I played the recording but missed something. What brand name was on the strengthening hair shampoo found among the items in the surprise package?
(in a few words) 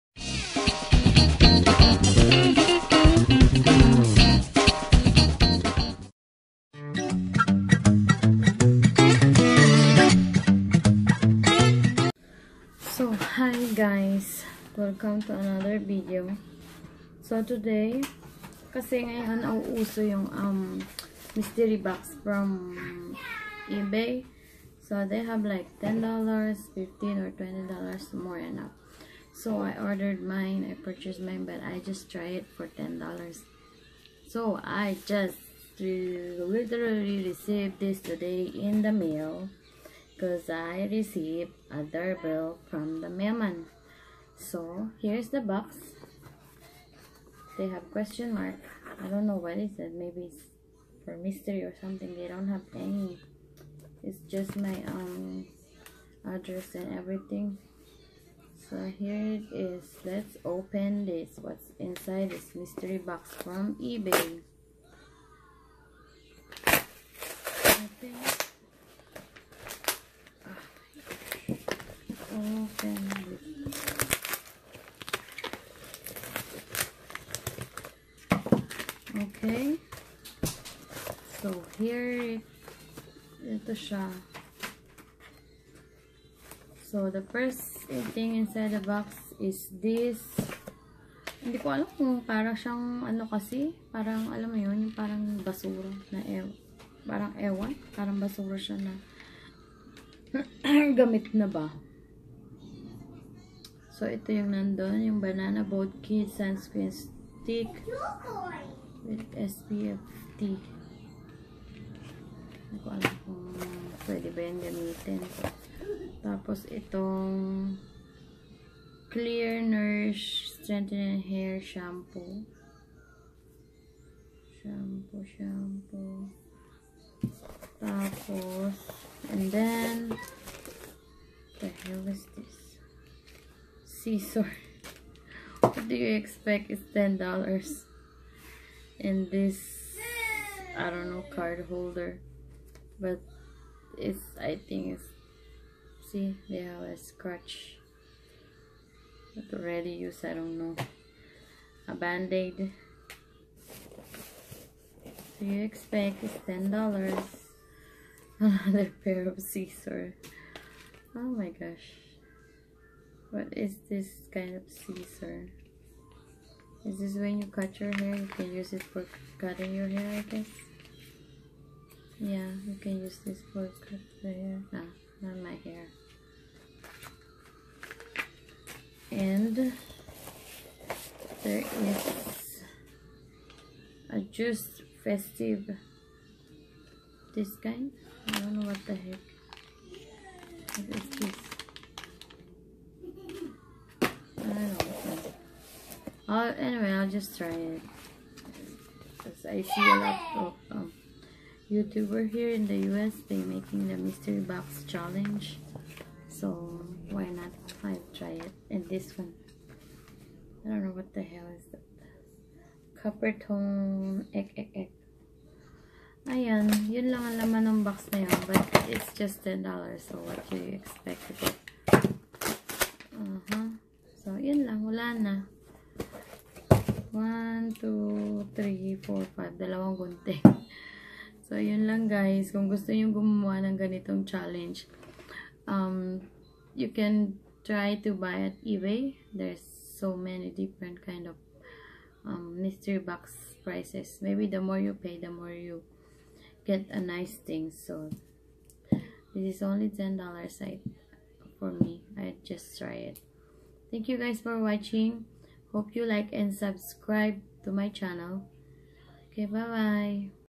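Clear.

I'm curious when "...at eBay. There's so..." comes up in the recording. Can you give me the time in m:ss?
3:58.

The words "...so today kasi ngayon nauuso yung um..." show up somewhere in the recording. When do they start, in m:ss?
0:17.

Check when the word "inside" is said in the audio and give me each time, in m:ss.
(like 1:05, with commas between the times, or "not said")
1:01, 1:28.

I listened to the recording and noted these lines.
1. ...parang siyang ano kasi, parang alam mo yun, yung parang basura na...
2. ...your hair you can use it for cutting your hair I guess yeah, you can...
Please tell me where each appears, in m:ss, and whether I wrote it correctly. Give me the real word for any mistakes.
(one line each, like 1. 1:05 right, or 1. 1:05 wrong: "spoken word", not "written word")
1. 1:32 right
2. 2:47 right.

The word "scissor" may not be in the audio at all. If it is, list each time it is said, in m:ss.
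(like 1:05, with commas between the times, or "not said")
2:13, 2:39, 2:44.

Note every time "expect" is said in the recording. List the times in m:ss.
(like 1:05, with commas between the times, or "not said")
2:16, 2:35, 3:40.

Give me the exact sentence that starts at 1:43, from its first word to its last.
So, ito yung nandun, yung Banana Boat Kid Sunscreen Stick with SPF tea.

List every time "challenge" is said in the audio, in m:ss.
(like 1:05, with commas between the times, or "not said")
3:24, 3:54.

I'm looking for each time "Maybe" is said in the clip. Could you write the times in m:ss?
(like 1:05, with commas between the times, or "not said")
0:49, 4:04.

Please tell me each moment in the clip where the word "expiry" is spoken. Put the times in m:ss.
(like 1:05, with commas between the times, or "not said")
not said.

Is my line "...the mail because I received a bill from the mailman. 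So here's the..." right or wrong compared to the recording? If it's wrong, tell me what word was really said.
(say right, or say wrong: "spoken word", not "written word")
right.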